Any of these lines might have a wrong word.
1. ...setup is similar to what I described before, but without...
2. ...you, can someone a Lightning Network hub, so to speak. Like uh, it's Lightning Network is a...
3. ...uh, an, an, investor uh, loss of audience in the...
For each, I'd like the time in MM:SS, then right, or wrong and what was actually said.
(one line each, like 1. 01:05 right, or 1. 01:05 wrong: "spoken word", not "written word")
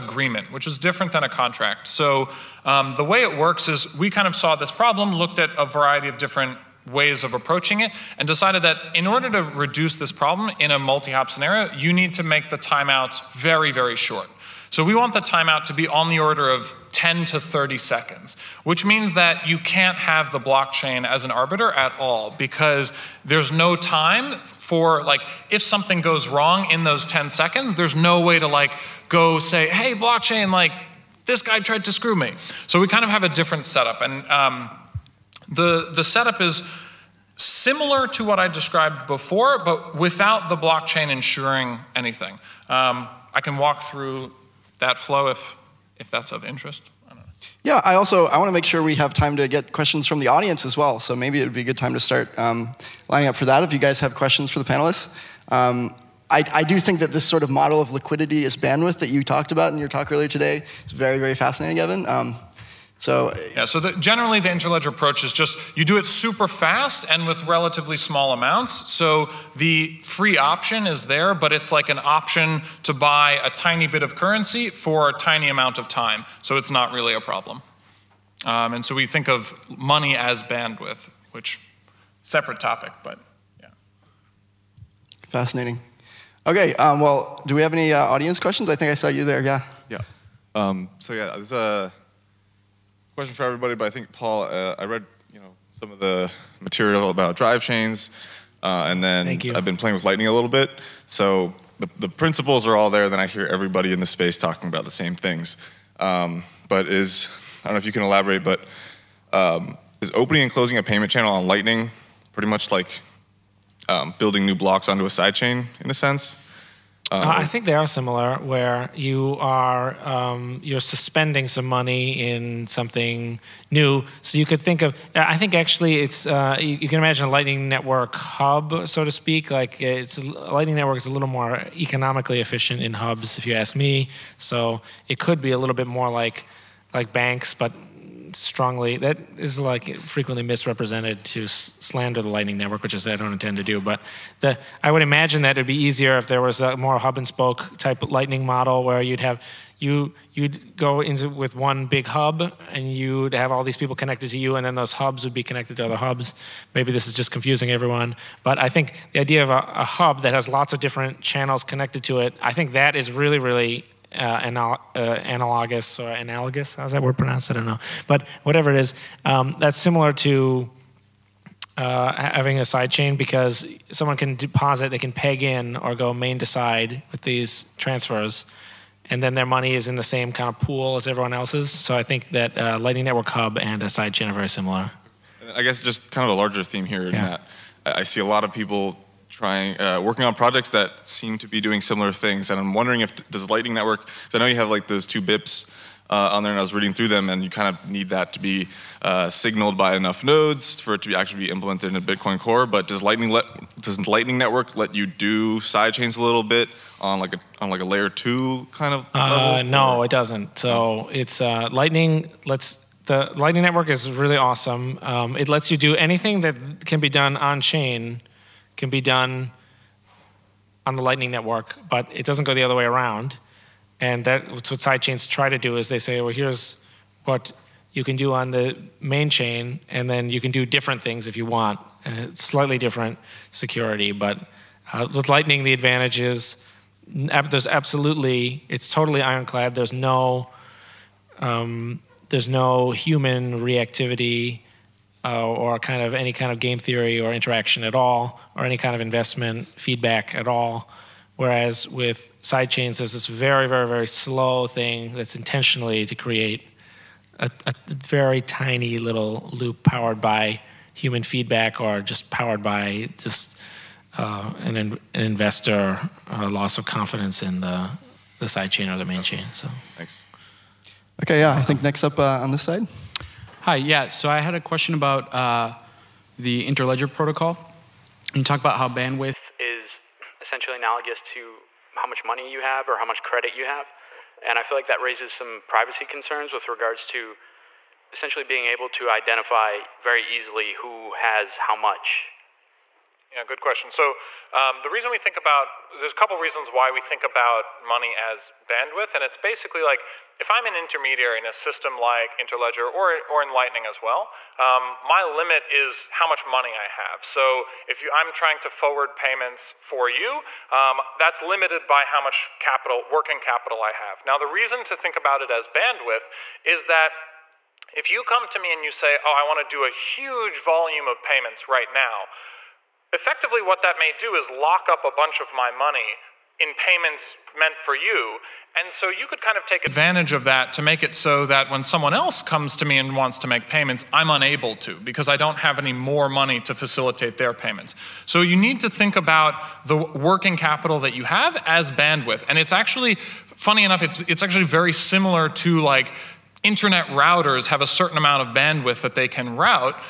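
1. 00:36 right
2. 02:06 wrong: "imagine", not "someone"
3. 04:24 wrong: "confidence", not "audience".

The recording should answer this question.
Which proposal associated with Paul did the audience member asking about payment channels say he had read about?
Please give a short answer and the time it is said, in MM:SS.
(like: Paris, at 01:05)
drive chains, at 01:37.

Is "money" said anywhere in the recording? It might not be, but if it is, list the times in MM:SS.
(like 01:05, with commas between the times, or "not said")
01:19, 02:01, 02:59, 04:42, 04:57, 05:06, 05:25, 05:36.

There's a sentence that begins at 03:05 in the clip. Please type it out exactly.
I guess just kind of a larger theme here yeah.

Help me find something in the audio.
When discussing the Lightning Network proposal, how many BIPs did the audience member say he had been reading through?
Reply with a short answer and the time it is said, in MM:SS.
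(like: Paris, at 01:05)
2, at 03:15.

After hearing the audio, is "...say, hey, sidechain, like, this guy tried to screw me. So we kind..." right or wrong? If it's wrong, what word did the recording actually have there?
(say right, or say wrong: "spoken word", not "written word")
wrong: "blockchain", not "sidechain".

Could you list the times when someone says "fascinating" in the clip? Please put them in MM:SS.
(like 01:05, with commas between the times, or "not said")
01:01, 01:25.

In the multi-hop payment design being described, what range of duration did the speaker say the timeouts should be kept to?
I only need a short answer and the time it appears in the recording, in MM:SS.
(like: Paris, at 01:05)
10 to 30 seconds, at 00:16.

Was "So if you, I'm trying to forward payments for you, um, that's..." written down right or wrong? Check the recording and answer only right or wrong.
right.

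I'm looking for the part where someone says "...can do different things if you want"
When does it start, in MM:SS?
03:50.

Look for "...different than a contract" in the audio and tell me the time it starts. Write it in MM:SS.
00:00.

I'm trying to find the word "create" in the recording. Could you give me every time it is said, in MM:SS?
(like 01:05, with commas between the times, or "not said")
04:16.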